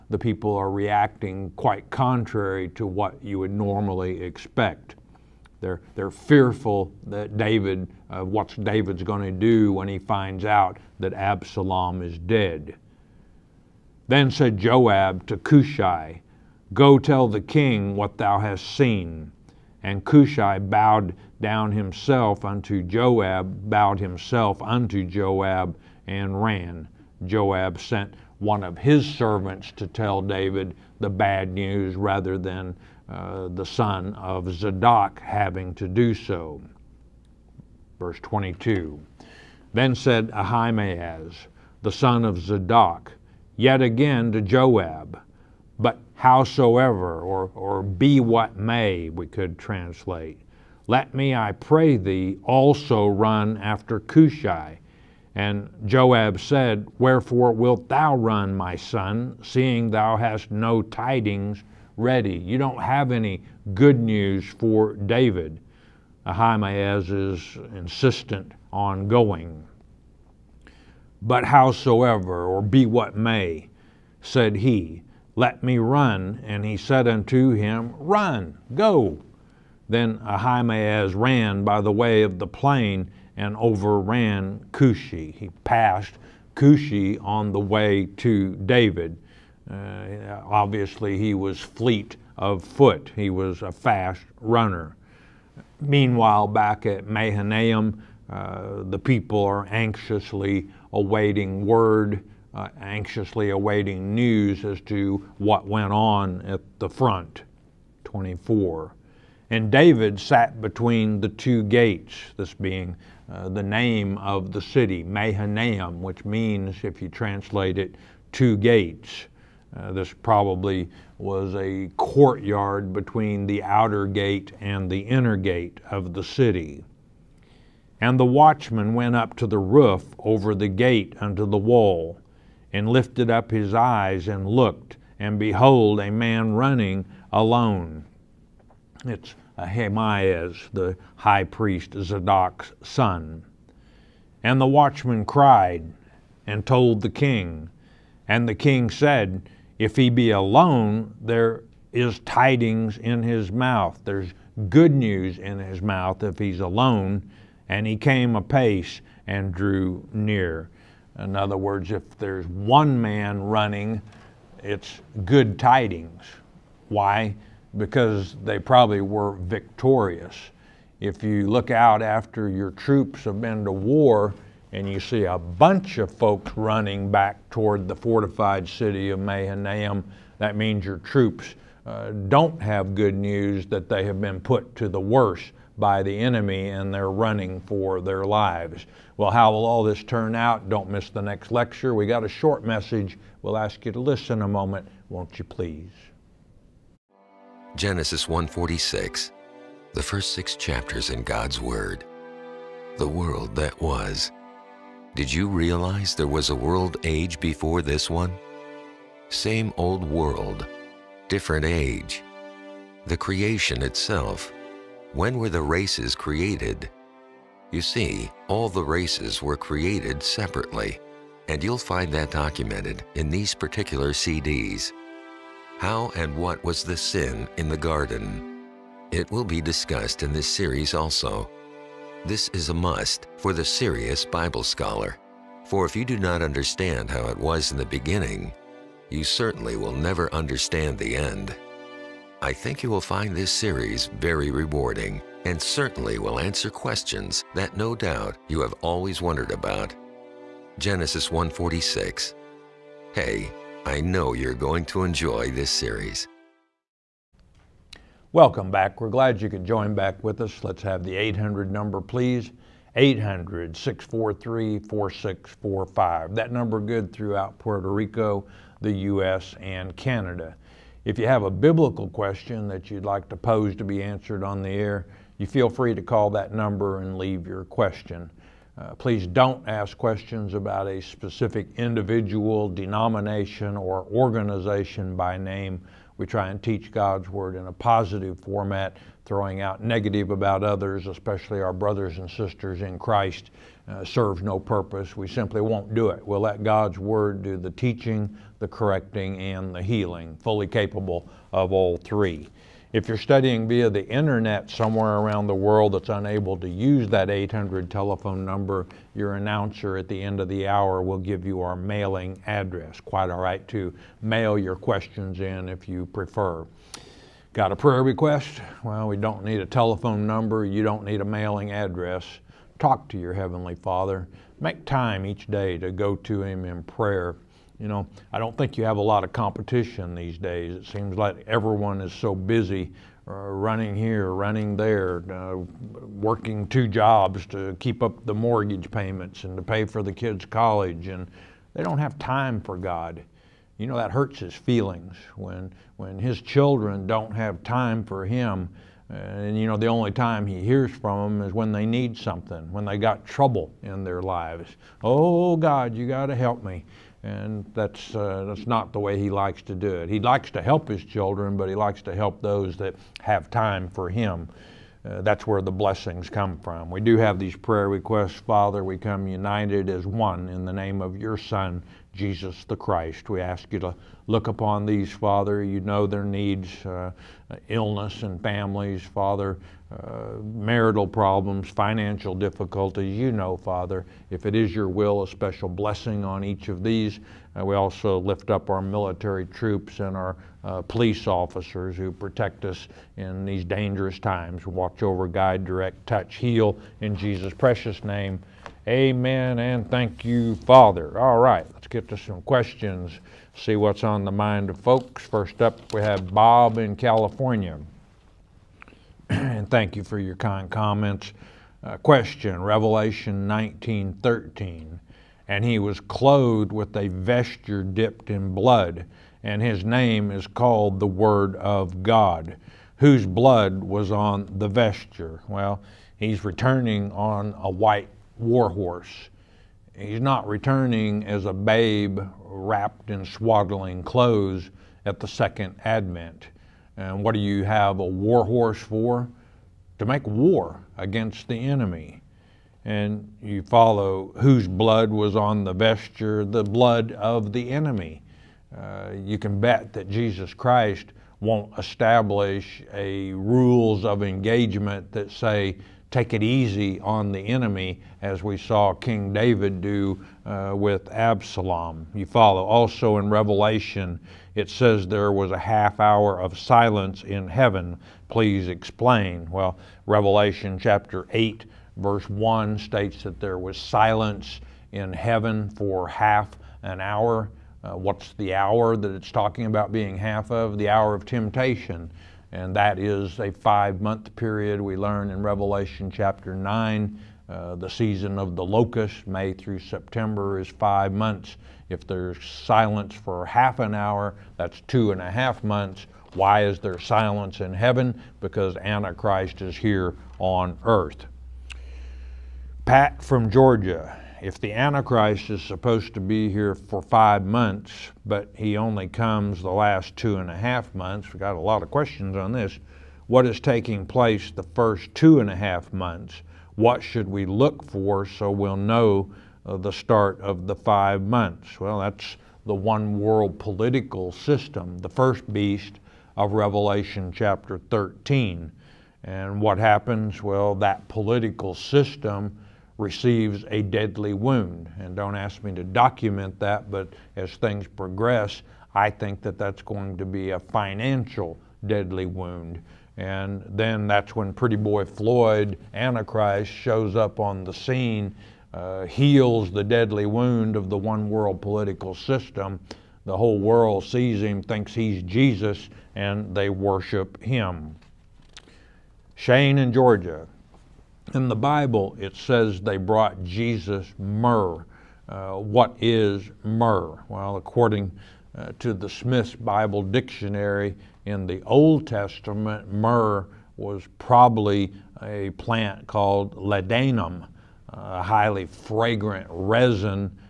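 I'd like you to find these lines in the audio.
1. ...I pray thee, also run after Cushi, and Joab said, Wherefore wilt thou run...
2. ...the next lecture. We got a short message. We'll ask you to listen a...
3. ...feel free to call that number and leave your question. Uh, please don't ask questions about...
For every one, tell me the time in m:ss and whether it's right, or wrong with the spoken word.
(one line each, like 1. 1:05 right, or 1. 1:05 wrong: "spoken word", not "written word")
1. 0:51 right
2. 3:11 right
3. 4:35 right.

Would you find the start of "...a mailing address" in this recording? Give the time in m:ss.
5:21.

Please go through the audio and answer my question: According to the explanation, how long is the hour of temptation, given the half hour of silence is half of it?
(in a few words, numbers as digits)
5 months.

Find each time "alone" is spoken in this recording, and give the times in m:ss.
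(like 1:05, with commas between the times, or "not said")
2:17, 2:30, 2:36.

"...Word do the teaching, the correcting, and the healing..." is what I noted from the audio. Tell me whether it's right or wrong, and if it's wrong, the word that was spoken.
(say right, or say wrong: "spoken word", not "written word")
right.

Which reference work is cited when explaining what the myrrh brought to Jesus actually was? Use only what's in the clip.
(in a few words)
Smith's Bible Dictionary.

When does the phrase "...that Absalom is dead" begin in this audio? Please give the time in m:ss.
0:10.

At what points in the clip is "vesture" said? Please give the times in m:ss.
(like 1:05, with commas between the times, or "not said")
6:57, 7:04, 7:25.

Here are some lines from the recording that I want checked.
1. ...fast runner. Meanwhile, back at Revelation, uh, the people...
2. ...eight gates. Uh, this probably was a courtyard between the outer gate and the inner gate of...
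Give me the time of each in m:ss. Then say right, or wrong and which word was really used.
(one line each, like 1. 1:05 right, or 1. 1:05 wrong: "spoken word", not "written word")
1. 1:33 wrong: "Mahanaim", not "Revelation"
2. 1:58 wrong: "two", not "eight".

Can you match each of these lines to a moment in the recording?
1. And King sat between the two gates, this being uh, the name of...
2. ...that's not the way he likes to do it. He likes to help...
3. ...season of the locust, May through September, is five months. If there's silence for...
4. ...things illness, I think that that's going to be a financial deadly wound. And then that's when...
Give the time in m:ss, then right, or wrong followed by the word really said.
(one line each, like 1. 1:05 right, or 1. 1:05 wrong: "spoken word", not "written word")
1. 1:49 wrong: "David", not "King"
2. 5:58 right
3. 8:07 right
4. 8:57 wrong: "progress", not "illness".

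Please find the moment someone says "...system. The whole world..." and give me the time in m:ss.
9:12.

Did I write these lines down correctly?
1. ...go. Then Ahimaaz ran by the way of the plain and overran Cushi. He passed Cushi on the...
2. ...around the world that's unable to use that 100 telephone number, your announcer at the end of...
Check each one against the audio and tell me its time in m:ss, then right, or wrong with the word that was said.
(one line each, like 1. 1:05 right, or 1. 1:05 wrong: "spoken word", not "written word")
1. 1:18 right
2. 5:05 wrong: "800", not "100".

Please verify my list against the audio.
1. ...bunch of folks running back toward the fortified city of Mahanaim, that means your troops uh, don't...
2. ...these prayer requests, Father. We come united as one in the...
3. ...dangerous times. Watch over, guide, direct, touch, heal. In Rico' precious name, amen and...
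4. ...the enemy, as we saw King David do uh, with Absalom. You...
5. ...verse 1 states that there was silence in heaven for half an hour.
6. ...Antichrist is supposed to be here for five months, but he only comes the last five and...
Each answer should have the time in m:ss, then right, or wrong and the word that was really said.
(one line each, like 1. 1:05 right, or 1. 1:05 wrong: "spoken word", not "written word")
1. 2:55 right
2. 6:07 right
3. 6:33 wrong: "Jesus", not "Rico"
4. 7:37 right
5. 7:51 right
6. 8:24 wrong: "two", not "five".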